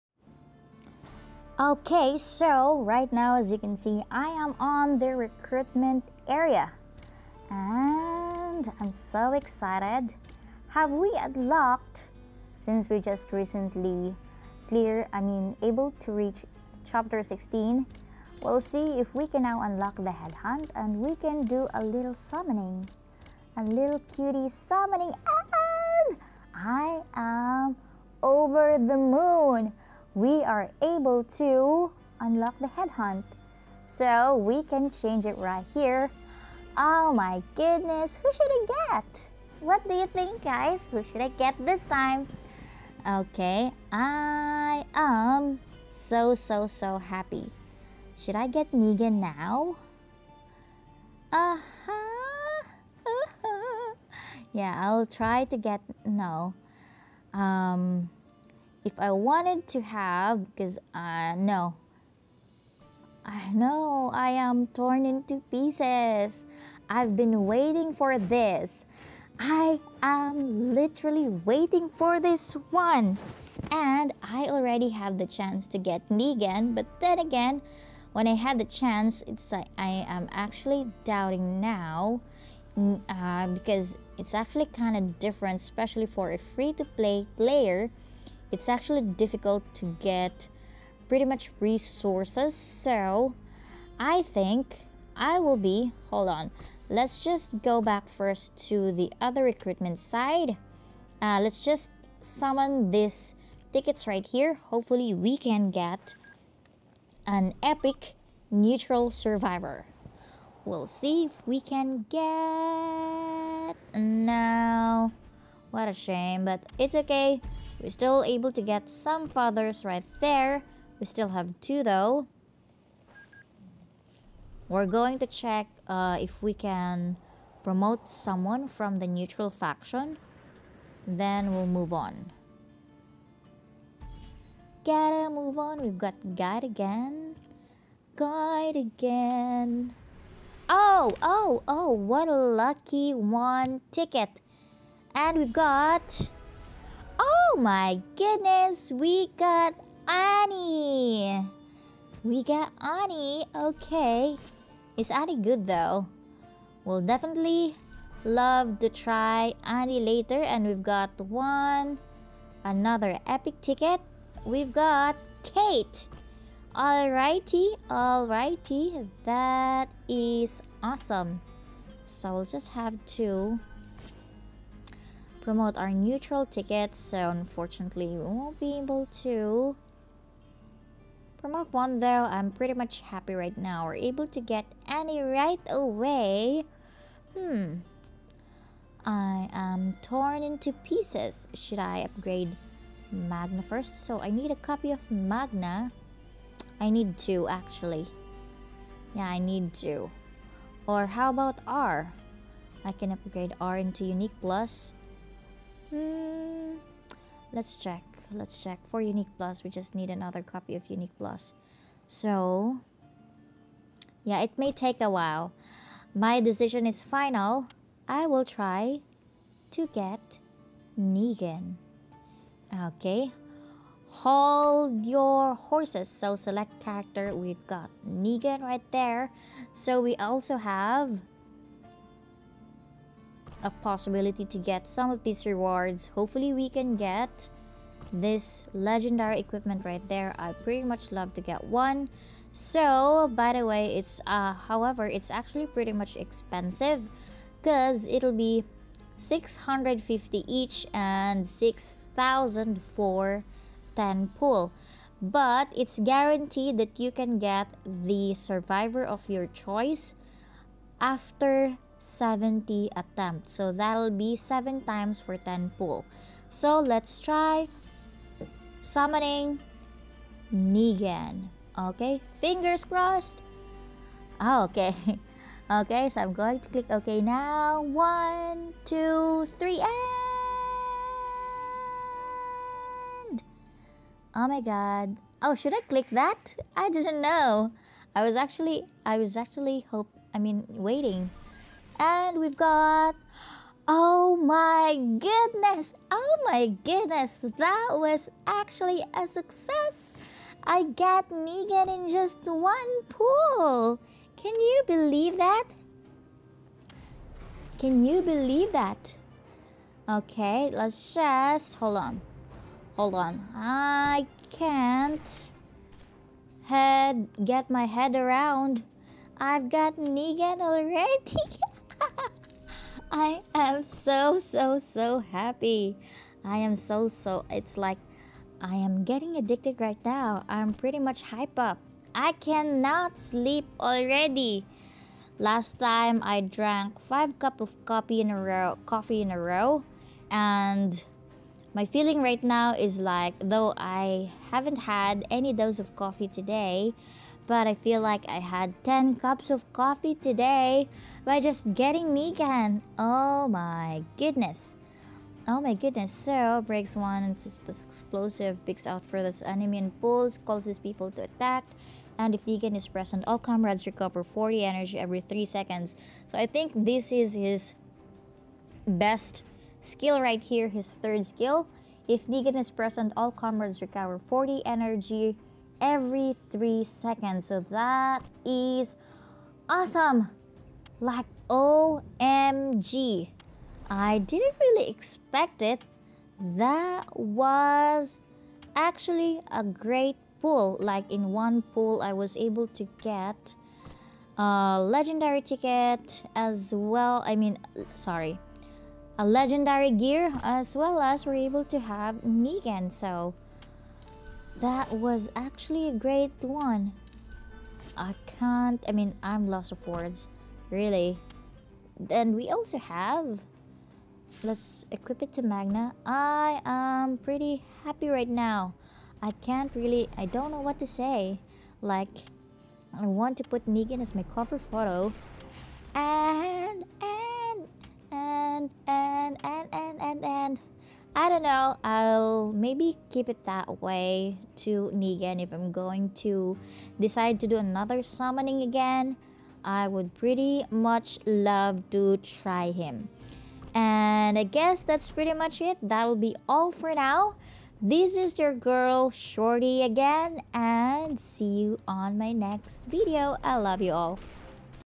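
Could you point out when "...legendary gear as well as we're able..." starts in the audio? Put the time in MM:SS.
06:39.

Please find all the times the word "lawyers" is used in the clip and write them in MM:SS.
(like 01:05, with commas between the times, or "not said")
not said.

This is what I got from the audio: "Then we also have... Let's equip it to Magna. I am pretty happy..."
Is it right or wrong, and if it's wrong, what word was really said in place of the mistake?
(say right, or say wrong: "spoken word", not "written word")
right.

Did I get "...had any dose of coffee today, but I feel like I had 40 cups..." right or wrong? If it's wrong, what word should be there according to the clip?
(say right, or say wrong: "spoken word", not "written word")
wrong: "10", not "40".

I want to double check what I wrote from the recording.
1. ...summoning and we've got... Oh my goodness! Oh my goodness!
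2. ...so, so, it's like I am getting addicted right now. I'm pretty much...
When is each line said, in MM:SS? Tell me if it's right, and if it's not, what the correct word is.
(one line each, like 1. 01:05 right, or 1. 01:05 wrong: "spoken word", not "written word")
1. 04:50 wrong: "waiting", not "summoning"
2. 05:26 right.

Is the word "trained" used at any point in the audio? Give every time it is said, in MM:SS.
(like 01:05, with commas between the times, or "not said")
not said.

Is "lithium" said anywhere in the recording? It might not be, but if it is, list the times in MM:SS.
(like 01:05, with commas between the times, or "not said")
not said.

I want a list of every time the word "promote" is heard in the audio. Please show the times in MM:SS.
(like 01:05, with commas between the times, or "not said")
02:07, 02:55, 03:01.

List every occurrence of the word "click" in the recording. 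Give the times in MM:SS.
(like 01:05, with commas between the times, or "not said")
04:36, 04:45.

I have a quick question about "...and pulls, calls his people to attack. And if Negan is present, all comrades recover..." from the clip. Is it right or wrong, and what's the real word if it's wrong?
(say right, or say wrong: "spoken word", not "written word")
right.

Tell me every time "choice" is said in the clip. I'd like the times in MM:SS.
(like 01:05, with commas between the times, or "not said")
04:19.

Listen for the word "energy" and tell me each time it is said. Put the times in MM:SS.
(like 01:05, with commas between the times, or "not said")
06:04, 06:14.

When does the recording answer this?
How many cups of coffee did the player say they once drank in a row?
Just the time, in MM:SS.
05:37.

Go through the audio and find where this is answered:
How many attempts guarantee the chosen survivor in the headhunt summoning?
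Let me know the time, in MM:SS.
04:22.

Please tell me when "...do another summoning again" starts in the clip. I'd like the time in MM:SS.
07:17.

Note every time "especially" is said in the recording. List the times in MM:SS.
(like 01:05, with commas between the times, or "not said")
01:25.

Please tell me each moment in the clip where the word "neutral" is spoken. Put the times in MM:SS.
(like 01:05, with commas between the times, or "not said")
01:48, 02:09, 02:55.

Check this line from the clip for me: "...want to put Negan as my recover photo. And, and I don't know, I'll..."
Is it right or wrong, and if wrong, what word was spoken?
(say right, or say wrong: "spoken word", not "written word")
wrong: "cover", not "recover".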